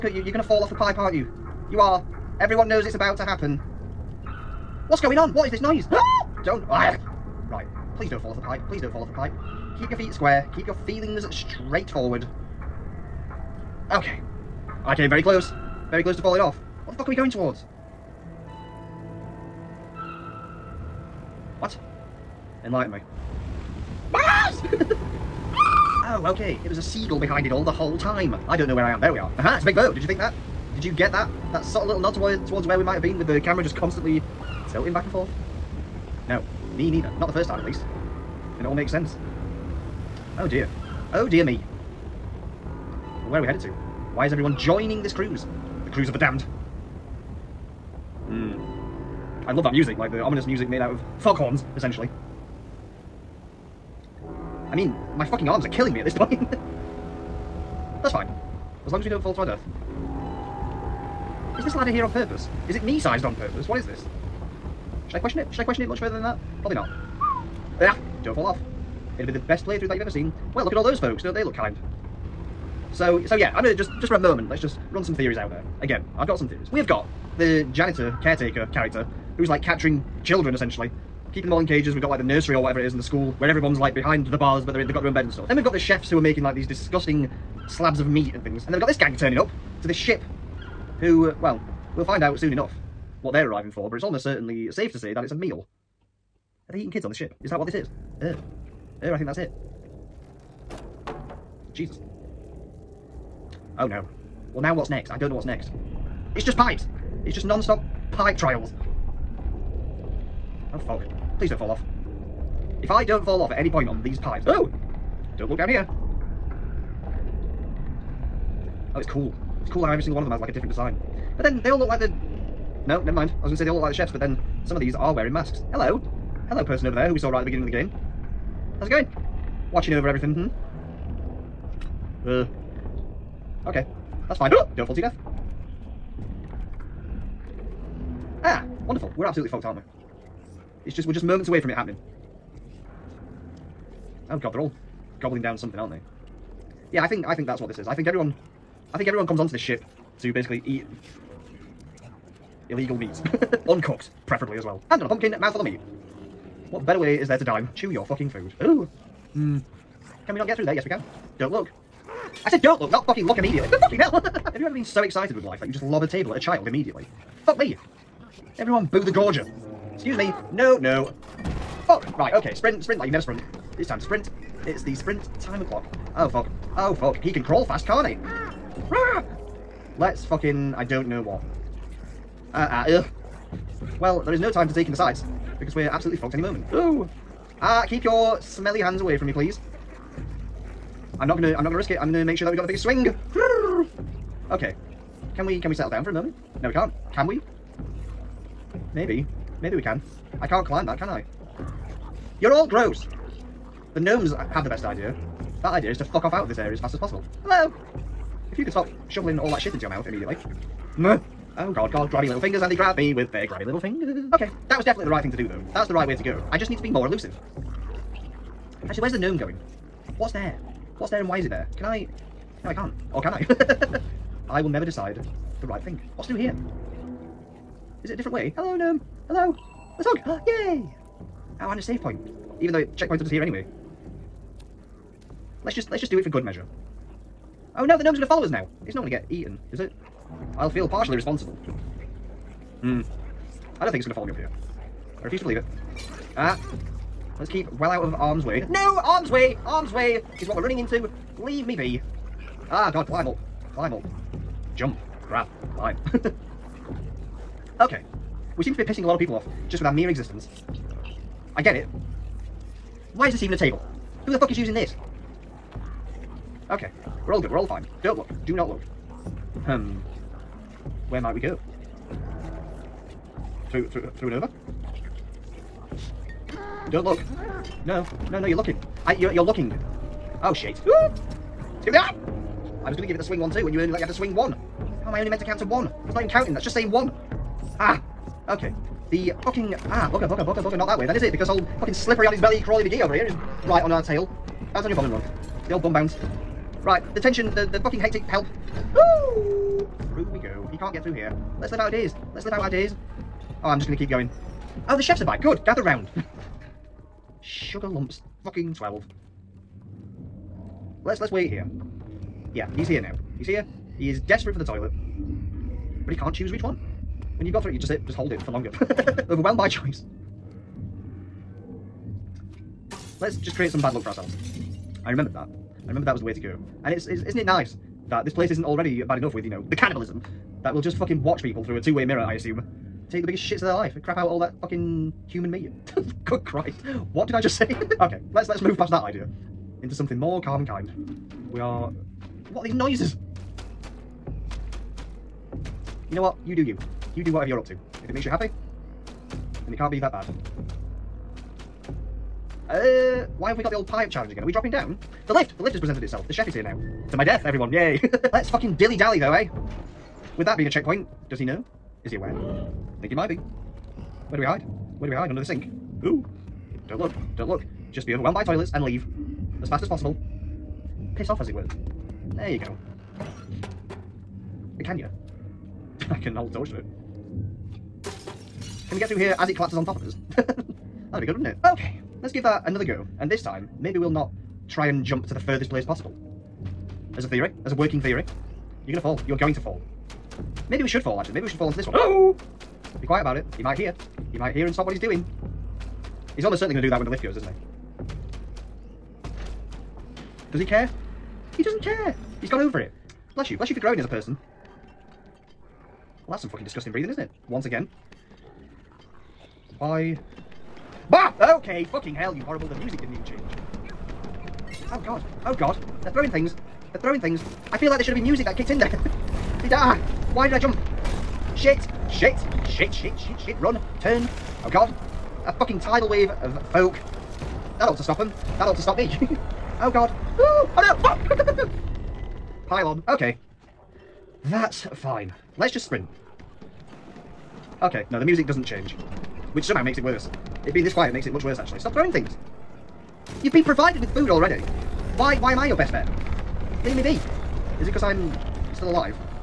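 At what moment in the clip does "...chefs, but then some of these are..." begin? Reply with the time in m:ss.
2:03.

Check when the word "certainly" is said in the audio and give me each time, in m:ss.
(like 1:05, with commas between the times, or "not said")
1:34, 6:36.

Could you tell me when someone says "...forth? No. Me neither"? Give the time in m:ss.
0:35.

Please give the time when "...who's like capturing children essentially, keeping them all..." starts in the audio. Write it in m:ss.
1:19.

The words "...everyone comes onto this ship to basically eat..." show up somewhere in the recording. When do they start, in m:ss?
2:29.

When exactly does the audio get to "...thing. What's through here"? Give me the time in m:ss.
3:45.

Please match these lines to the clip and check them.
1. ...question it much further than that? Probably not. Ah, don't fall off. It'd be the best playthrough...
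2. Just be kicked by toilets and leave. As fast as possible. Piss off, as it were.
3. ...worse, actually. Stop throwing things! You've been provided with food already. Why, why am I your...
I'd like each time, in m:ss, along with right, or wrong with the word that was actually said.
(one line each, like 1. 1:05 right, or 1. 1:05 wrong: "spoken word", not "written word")
1. 1:05 right
2. 6:07 wrong: "overwhelmed", not "kicked"
3. 7:21 right.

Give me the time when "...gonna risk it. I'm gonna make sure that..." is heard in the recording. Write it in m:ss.
3:11.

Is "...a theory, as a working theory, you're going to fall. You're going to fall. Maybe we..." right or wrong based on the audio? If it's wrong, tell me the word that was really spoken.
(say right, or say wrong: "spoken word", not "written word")
right.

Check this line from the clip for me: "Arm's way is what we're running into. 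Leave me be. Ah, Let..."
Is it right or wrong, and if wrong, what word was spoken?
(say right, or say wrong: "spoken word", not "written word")
wrong: "God", not "Let".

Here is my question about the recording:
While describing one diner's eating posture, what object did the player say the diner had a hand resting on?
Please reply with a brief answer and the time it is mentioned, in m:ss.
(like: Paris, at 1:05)
A pumpkin, at 2:35.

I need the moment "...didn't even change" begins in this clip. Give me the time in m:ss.
6:53.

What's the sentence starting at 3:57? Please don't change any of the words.
Oh no, the gnome's gonna follow us now.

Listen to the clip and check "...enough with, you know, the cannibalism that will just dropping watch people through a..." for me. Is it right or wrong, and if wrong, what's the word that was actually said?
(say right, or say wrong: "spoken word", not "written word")
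wrong: "fucking", not "dropping".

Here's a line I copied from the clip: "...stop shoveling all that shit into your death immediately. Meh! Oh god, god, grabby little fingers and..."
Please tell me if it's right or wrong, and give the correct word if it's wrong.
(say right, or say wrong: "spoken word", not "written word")
wrong: "mouth", not "death".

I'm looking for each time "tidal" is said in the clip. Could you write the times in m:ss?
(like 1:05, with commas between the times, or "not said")
7:05.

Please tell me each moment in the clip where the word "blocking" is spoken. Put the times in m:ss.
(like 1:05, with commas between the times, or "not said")
not said.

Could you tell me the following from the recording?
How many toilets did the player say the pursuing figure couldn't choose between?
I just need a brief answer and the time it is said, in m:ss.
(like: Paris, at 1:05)
3, at 5:17.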